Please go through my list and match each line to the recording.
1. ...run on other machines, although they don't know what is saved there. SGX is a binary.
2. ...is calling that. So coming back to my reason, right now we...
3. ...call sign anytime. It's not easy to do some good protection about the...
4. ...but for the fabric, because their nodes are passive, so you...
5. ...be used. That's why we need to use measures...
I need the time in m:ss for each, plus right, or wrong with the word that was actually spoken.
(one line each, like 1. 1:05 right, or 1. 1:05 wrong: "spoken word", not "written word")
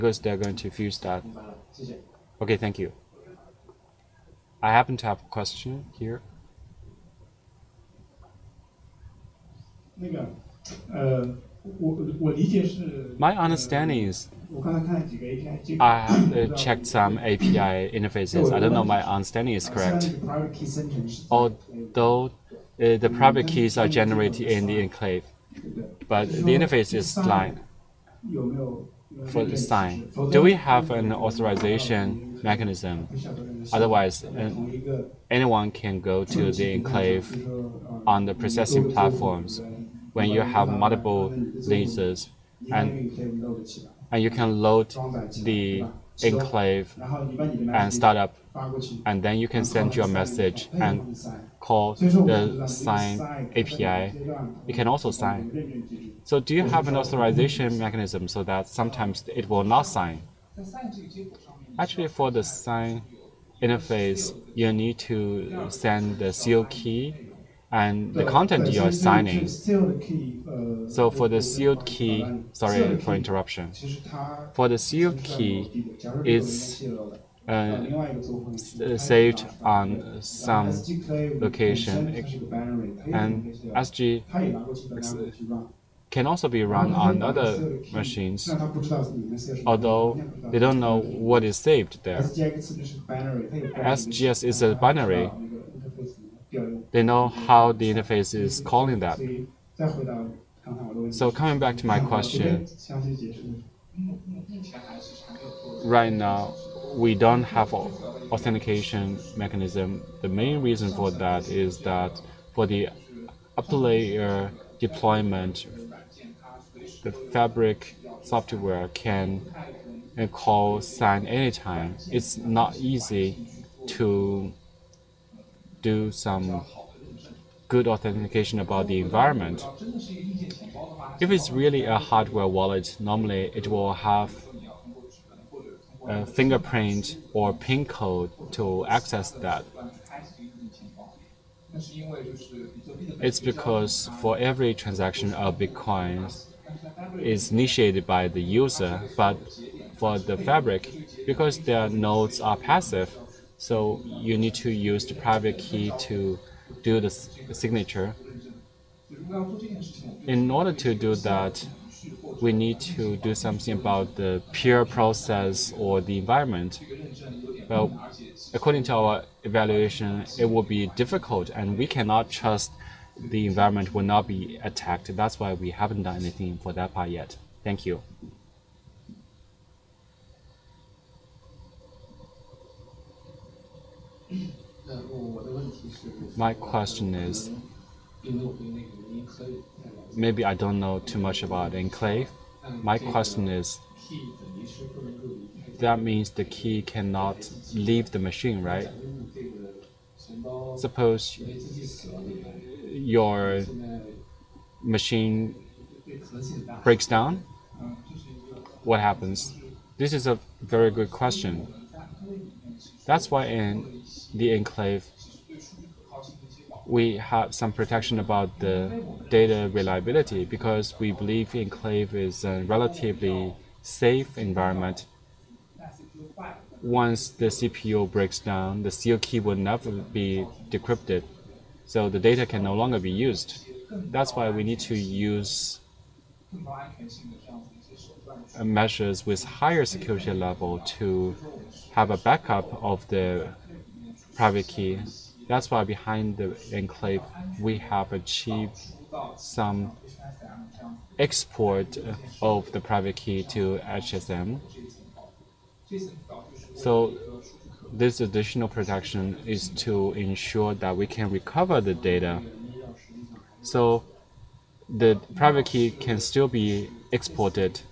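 1. 1:26 right
2. 1:38 wrong: "question", not "reason"
3. 2:00 wrong: "authentication", not "protection"
4. 2:29 right
5. 3:52 right.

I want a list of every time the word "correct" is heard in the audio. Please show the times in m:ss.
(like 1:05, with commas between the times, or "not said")
0:19.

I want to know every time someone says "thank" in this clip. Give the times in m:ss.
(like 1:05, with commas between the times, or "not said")
0:02, 2:57.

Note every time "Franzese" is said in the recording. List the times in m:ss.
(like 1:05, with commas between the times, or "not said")
not said.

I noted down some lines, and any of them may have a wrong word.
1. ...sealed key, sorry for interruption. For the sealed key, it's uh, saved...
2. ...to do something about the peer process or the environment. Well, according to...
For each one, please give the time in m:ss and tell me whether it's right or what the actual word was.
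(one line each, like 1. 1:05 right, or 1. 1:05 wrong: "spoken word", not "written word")
1. 1:11 right
2. 2:42 right.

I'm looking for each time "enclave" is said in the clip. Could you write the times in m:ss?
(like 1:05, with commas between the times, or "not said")
0:24, 0:36, 0:46, 3:11, 3:34, 3:41, 4:06.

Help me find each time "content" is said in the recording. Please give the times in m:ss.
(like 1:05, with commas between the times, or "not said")
1:08.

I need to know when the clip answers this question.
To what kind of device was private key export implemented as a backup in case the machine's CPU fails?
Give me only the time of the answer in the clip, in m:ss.
4:13.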